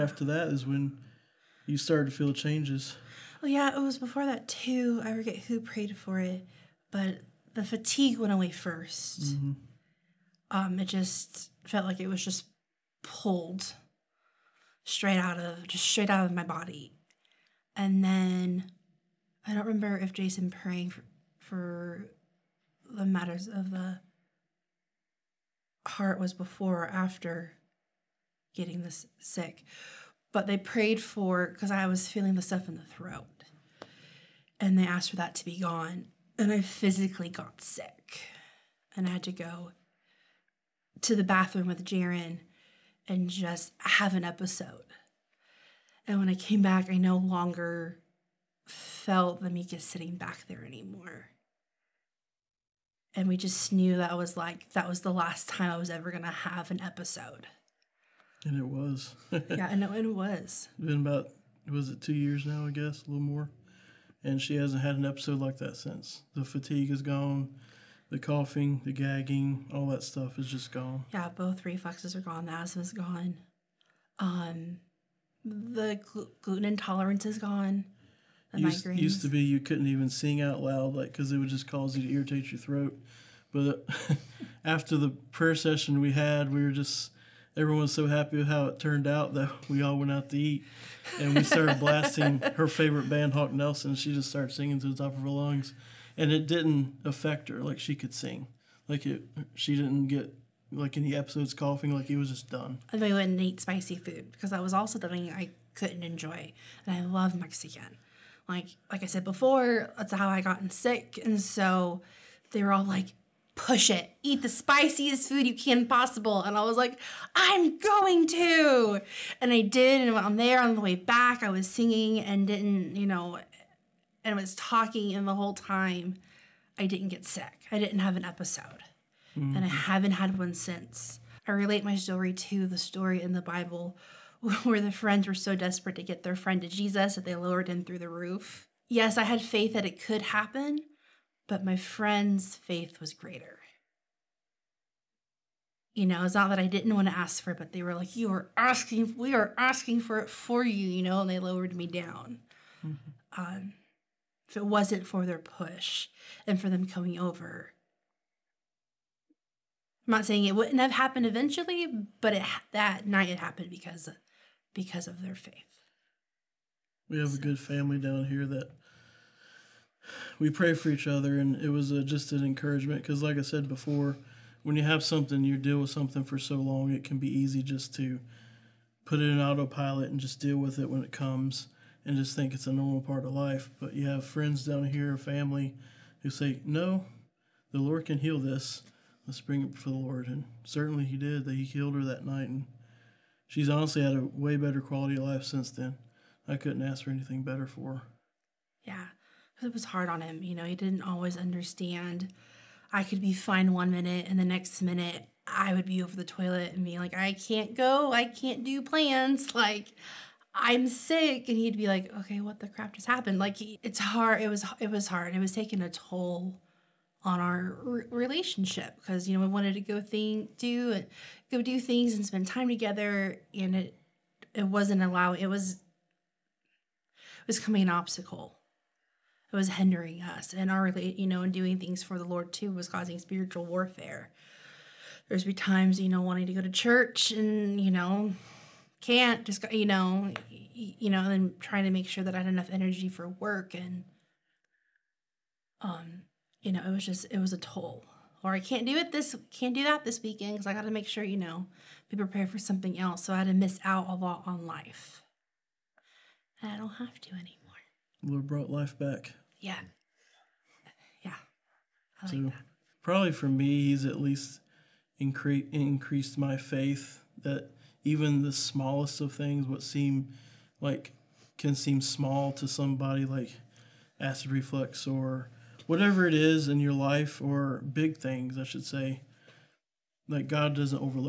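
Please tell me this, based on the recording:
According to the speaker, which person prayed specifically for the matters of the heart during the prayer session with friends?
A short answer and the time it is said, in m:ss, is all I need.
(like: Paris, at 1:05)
Jason, at 0:20.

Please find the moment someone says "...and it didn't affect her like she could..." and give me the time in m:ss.
1:36.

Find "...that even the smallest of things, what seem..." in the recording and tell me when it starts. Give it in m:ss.
4:27.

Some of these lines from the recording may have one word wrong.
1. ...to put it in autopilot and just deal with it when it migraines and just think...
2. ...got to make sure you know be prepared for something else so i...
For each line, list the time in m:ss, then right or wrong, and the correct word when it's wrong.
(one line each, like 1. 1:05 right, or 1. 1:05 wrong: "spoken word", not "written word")
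1. 2:57 wrong: "comes", not "migraines"
2. 4:10 right.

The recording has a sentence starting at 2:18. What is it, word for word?
Yes, I had faith that it could happen, but my friend's faith was greater.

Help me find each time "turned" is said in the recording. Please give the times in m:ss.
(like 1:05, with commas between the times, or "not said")
1:28.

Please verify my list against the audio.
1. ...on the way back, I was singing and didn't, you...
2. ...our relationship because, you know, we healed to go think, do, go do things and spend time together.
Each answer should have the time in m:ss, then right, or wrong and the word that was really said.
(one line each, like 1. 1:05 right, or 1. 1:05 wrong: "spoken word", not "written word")
1. 2:00 right
2. 3:37 wrong: "wanted", not "healed".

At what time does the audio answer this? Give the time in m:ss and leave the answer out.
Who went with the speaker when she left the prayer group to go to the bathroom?
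0:41.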